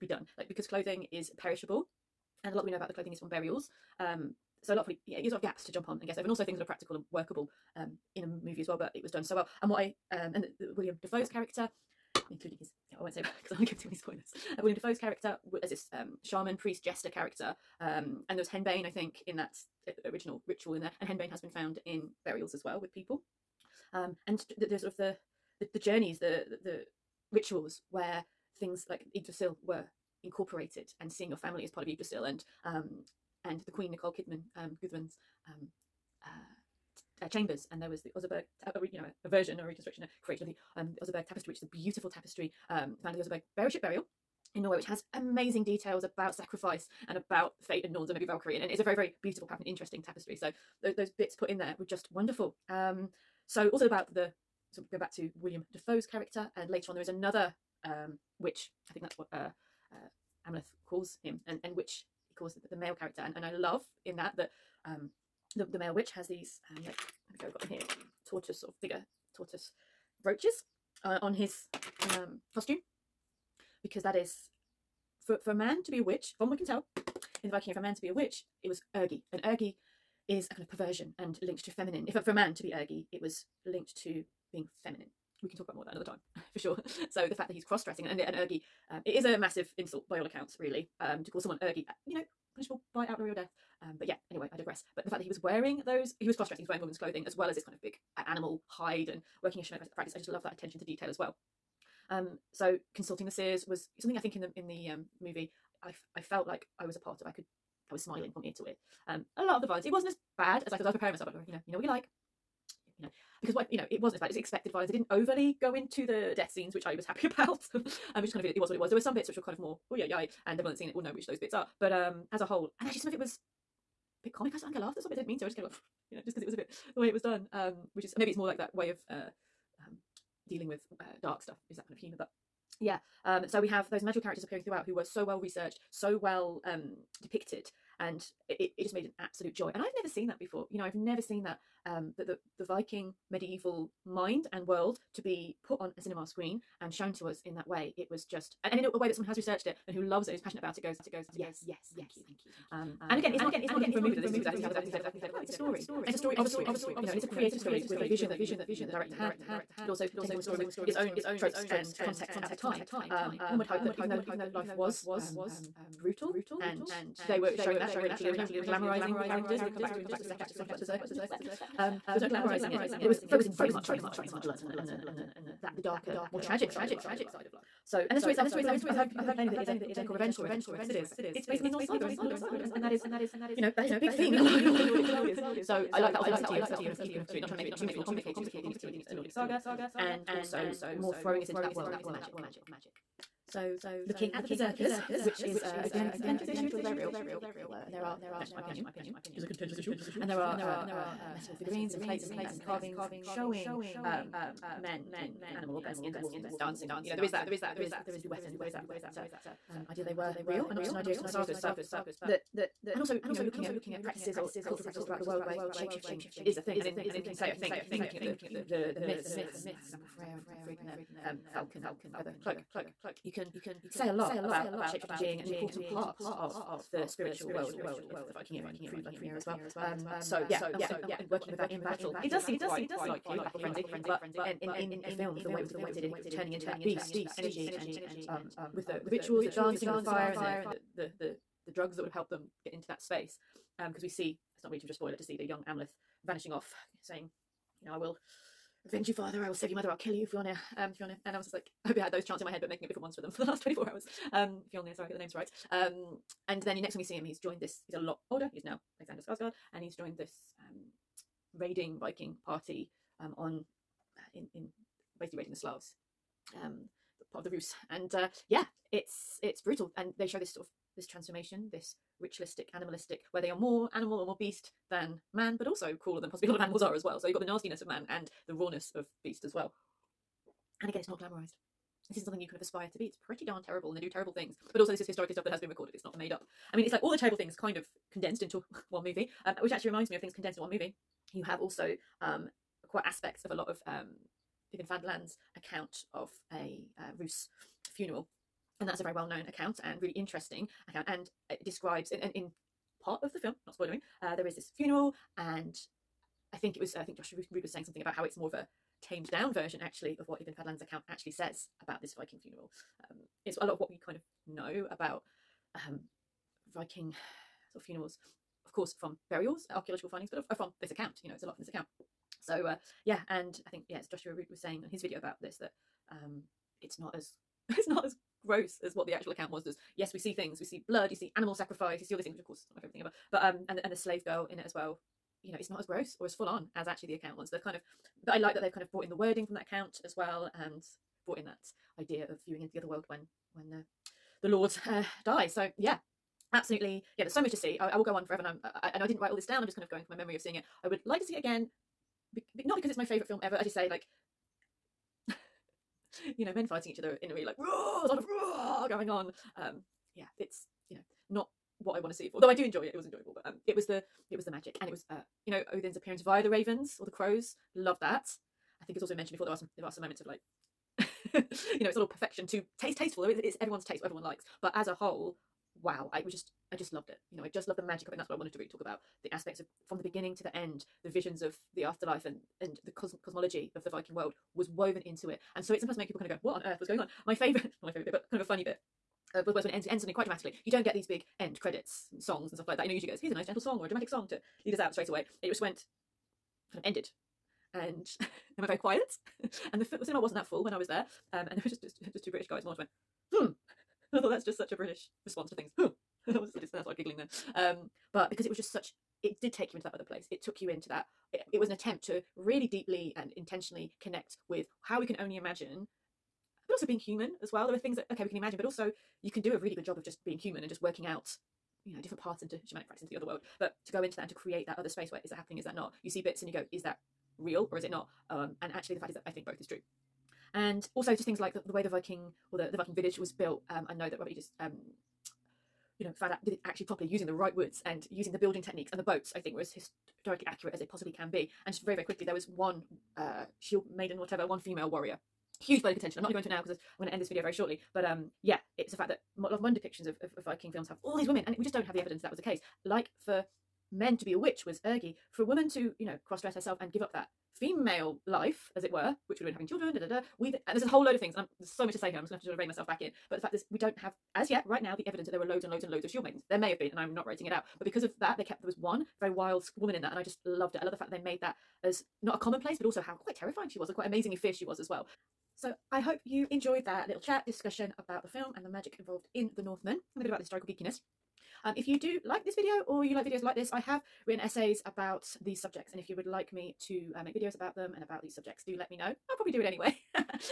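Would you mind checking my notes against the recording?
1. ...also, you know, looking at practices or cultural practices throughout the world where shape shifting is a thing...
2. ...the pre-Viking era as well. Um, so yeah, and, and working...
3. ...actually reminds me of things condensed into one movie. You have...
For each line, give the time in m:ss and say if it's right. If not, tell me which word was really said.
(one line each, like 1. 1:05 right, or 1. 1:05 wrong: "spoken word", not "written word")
1. 3:32 right
2. 3:48 right
3. 4:49 right.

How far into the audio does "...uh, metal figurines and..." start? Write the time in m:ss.
3:21.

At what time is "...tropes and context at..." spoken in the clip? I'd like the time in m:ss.
2:41.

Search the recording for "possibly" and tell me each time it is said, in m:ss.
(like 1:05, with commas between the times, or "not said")
4:36, 7:20.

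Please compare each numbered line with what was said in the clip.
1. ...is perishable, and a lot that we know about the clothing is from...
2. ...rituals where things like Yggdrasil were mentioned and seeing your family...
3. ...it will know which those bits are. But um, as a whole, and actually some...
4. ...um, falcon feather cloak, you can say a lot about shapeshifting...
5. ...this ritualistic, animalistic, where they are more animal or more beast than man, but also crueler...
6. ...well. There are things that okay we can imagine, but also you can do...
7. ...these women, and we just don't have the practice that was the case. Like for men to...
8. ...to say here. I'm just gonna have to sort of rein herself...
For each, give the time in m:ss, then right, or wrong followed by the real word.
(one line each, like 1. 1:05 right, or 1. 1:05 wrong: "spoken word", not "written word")
1. 0:01 right
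2. 0:27 wrong: "incorporated", not "mentioned"
3. 2:00 right
4. 3:41 right
5. 4:31 right
6. 6:57 right
7. 7:31 wrong: "evidence", not "practice"
8. 7:41 wrong: "myself", not "herself".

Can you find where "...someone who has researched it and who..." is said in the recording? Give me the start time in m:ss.
2:29.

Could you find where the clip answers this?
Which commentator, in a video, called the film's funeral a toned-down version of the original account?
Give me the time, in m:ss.
5:07.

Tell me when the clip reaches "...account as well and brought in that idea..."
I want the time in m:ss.
5:39.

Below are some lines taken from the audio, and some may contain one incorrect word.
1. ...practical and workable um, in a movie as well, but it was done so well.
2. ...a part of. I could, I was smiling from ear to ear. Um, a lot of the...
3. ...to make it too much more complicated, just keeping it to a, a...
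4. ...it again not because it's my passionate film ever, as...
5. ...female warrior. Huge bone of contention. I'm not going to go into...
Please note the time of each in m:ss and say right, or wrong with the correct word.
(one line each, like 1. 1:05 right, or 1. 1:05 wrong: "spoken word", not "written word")
1. 0:06 right
2. 1:46 right
3. 3:07 right
4. 5:51 wrong: "favorite", not "passionate"
5. 7:24 right.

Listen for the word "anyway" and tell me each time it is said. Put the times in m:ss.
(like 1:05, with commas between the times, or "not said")
1:34, 8:09.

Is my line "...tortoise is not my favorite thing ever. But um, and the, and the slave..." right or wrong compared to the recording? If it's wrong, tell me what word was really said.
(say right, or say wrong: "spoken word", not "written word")
wrong: "course", not "tortoise".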